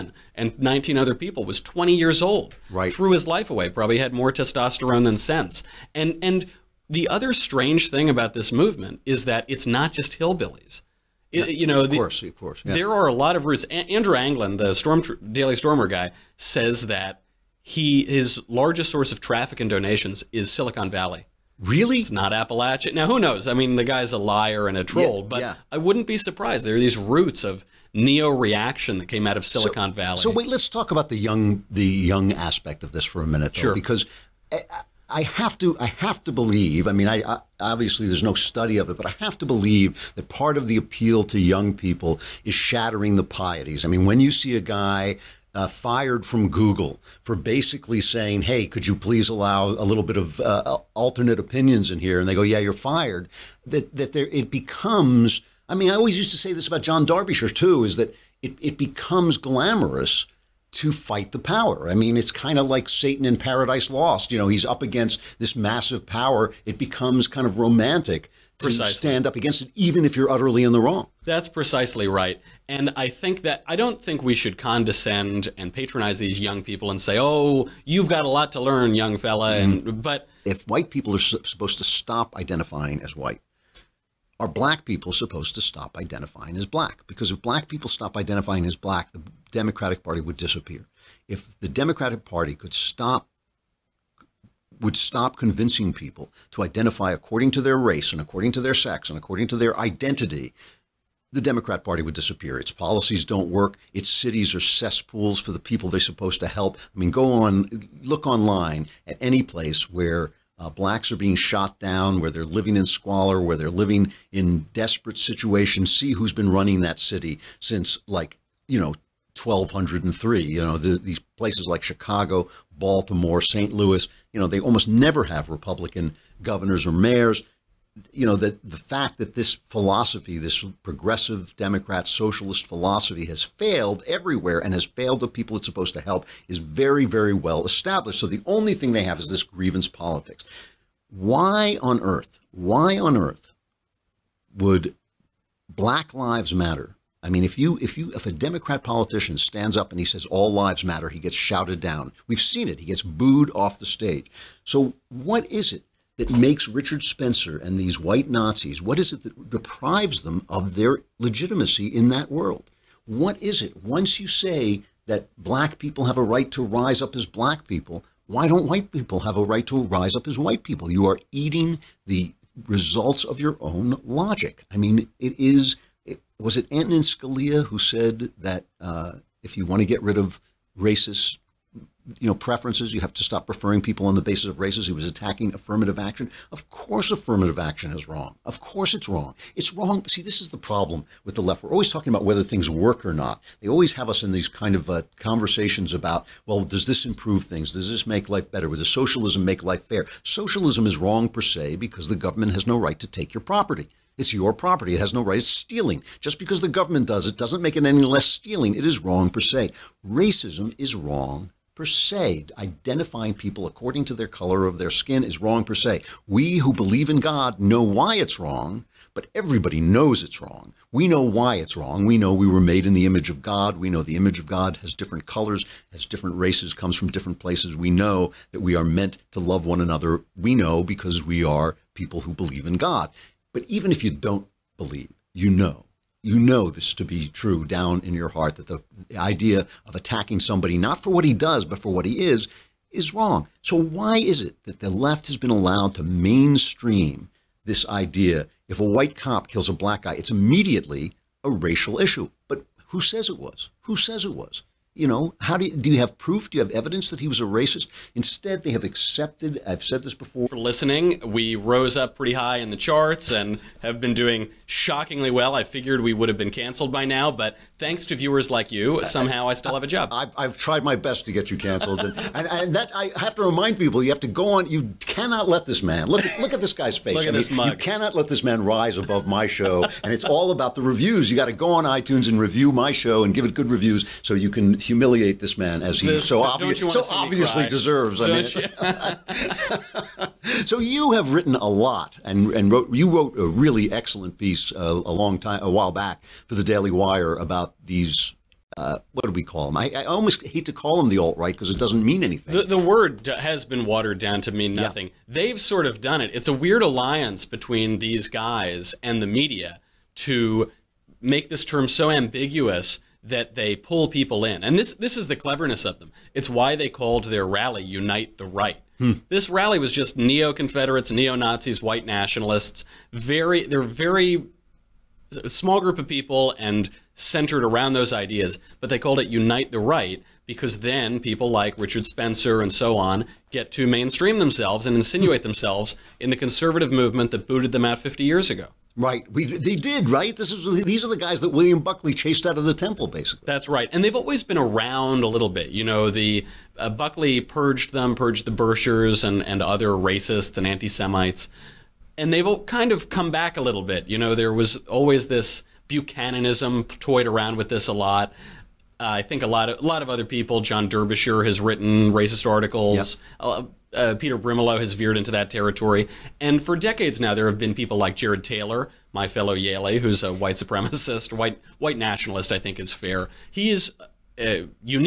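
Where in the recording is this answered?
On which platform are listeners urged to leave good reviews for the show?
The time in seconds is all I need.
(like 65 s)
281 s.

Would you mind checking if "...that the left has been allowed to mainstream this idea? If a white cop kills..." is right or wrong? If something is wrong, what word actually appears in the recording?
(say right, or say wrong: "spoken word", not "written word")
right.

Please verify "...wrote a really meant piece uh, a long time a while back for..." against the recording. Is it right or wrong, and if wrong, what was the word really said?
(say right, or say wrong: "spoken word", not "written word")
wrong: "excellent", not "meant".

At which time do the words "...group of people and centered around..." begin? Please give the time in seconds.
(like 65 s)
325 s.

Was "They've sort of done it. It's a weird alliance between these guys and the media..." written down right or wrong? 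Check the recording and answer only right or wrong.
right.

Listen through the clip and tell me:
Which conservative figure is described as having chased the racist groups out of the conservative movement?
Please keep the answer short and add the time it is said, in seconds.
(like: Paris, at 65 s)
William Buckley, at 341 s.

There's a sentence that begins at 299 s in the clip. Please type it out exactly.
I, I, almost hate to call them the alt right because it doesn't mean anything.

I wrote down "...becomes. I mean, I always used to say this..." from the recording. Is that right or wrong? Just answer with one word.
right.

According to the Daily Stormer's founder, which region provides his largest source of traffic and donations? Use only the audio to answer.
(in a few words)
Silicon Valley.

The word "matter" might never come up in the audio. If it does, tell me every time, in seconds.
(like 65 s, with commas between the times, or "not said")
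146 s, 150 s.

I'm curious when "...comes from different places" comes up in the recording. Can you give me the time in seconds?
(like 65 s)
226 s.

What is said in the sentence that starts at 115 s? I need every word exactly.
See who's been running that city since, like, you know, 1203.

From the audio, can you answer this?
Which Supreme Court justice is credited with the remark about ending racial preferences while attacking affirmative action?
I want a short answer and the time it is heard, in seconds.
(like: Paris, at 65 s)
Antonin Scalia, at 176 s.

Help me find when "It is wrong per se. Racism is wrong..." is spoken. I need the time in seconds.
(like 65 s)
208 s.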